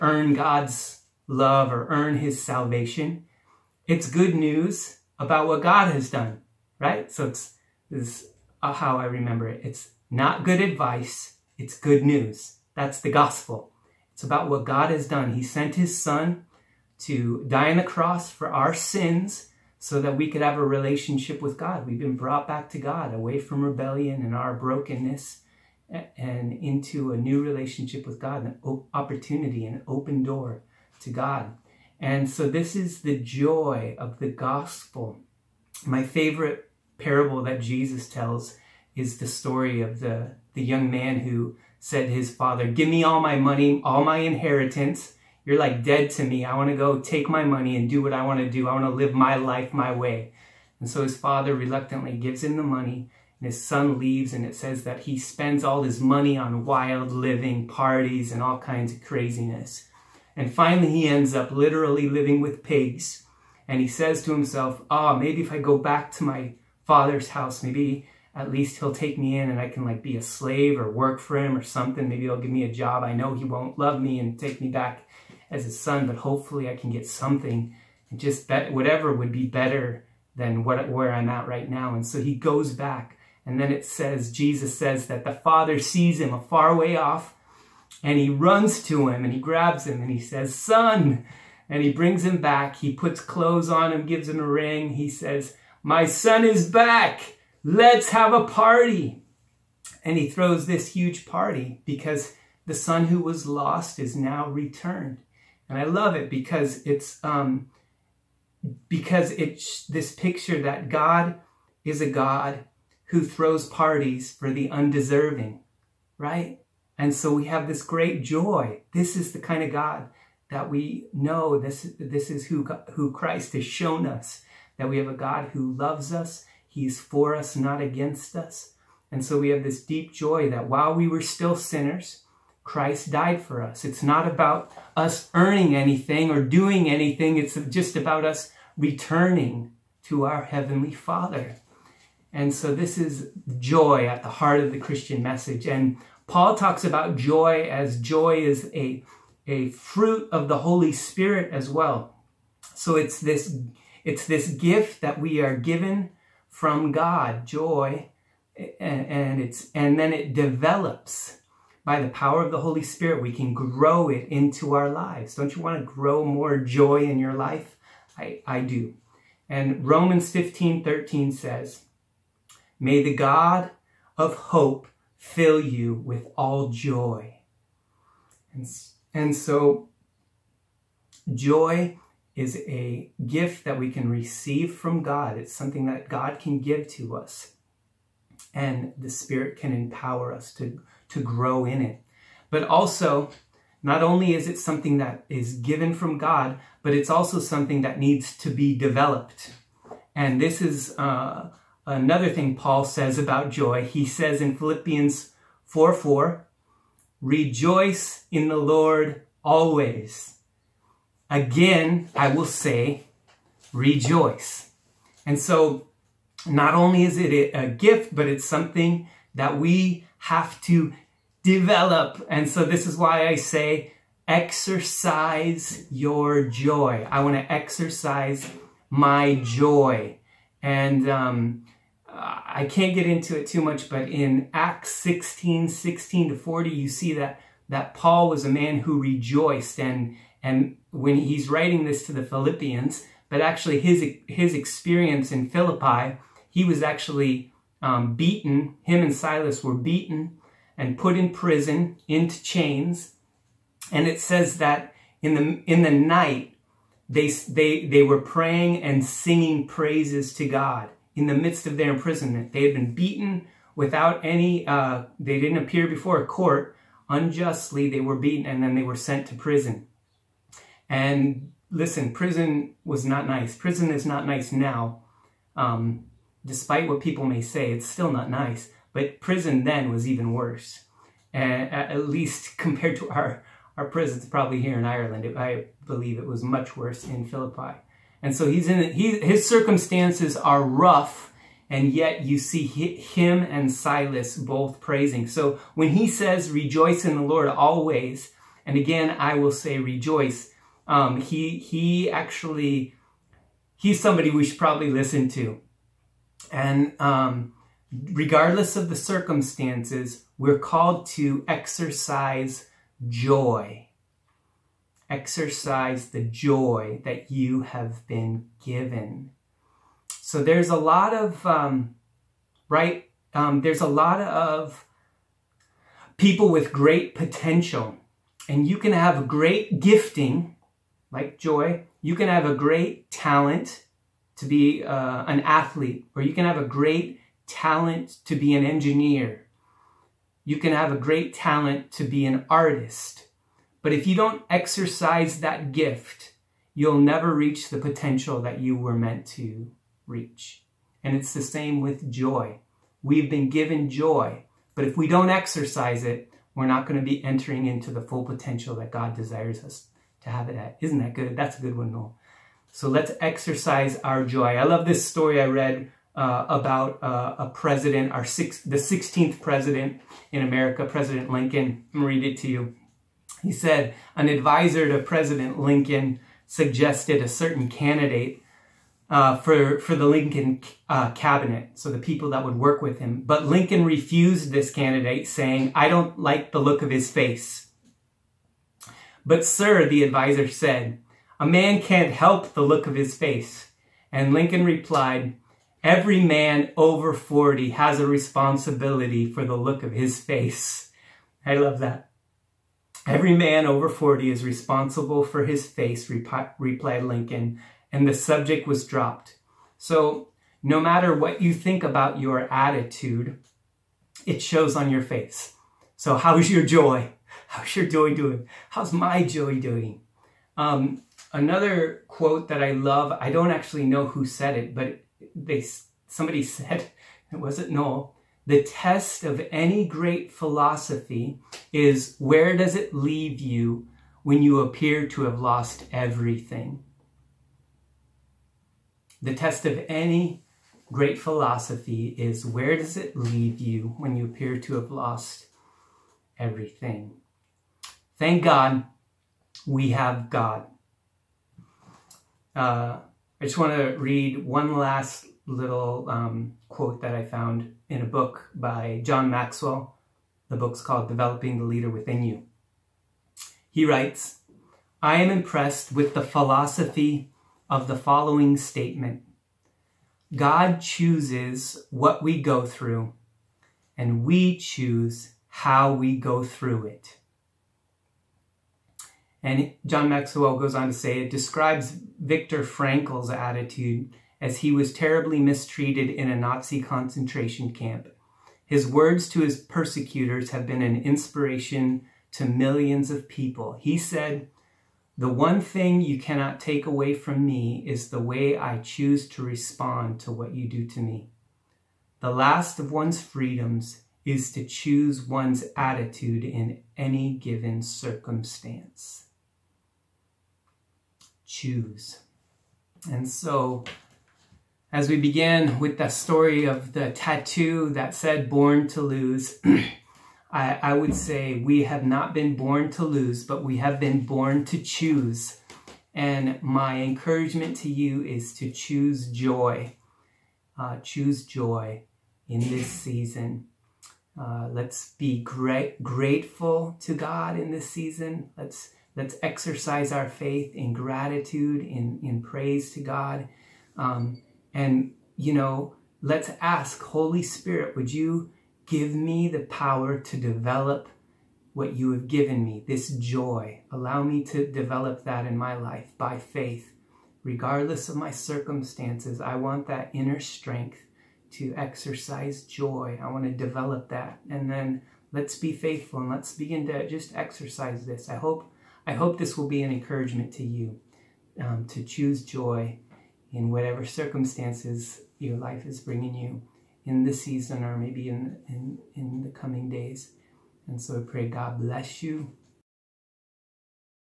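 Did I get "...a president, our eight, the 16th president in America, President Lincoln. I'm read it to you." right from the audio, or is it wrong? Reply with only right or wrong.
wrong.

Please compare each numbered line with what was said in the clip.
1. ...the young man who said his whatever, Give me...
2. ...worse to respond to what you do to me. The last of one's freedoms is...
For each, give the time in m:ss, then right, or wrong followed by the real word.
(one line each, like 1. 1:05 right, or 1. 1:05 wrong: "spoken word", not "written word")
1. 0:40 wrong: "father", not "whatever"
2. 8:18 wrong: "choose", not "worse".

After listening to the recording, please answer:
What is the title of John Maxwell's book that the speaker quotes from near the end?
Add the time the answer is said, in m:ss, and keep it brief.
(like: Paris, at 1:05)
Developing the Leader Within You, at 7:41.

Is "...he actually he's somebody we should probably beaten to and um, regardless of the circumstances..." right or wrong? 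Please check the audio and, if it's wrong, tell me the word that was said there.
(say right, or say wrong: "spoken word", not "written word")
wrong: "listen", not "beaten".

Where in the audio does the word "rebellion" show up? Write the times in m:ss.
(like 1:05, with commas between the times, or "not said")
0:23.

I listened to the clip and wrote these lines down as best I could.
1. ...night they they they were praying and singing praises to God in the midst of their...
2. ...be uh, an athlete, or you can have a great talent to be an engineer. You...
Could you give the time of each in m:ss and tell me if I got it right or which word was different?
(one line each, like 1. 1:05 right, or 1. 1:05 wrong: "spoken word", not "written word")
1. 4:15 right
2. 5:34 right.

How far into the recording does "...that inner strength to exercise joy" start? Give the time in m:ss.
9:19.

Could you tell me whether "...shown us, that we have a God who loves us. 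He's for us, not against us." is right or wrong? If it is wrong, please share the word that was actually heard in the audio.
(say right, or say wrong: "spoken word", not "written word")
right.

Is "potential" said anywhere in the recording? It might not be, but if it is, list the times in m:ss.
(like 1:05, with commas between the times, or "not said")
5:27, 5:47, 5:58.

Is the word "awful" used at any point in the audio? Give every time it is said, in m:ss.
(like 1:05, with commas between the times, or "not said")
not said.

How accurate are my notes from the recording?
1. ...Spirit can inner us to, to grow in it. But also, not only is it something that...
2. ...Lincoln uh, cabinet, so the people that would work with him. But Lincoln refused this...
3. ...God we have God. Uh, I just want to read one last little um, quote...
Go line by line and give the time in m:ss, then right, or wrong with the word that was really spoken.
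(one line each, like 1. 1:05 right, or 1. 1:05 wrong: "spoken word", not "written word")
1. 3:09 wrong: "empower", not "inner"
2. 6:20 right
3. 7:28 right.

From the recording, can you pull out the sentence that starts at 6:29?
But, sir, the advisor said, a man can't help the look of his face.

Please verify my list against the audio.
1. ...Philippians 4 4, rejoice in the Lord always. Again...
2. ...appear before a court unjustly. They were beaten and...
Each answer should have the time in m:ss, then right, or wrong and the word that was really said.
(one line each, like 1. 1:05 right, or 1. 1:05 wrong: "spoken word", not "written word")
1. 3:24 right
2. 4:25 right.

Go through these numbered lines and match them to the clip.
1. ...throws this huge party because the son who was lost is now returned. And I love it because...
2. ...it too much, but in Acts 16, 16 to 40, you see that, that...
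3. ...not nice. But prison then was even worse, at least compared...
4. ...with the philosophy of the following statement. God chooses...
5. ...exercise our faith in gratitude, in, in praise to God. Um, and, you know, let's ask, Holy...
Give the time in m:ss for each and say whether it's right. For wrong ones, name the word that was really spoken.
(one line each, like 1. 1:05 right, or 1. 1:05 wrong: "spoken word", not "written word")
1. 1:40 right
2. 3:53 right
3. 4:38 right
4. 7:45 right
5. 8:59 right.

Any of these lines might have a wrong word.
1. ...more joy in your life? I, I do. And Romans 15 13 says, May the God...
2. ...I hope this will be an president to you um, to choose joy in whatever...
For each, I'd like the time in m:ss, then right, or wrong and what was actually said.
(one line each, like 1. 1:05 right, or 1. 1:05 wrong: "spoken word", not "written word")
1. 2:46 right
2. 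9:29 wrong: "encouragement", not "president".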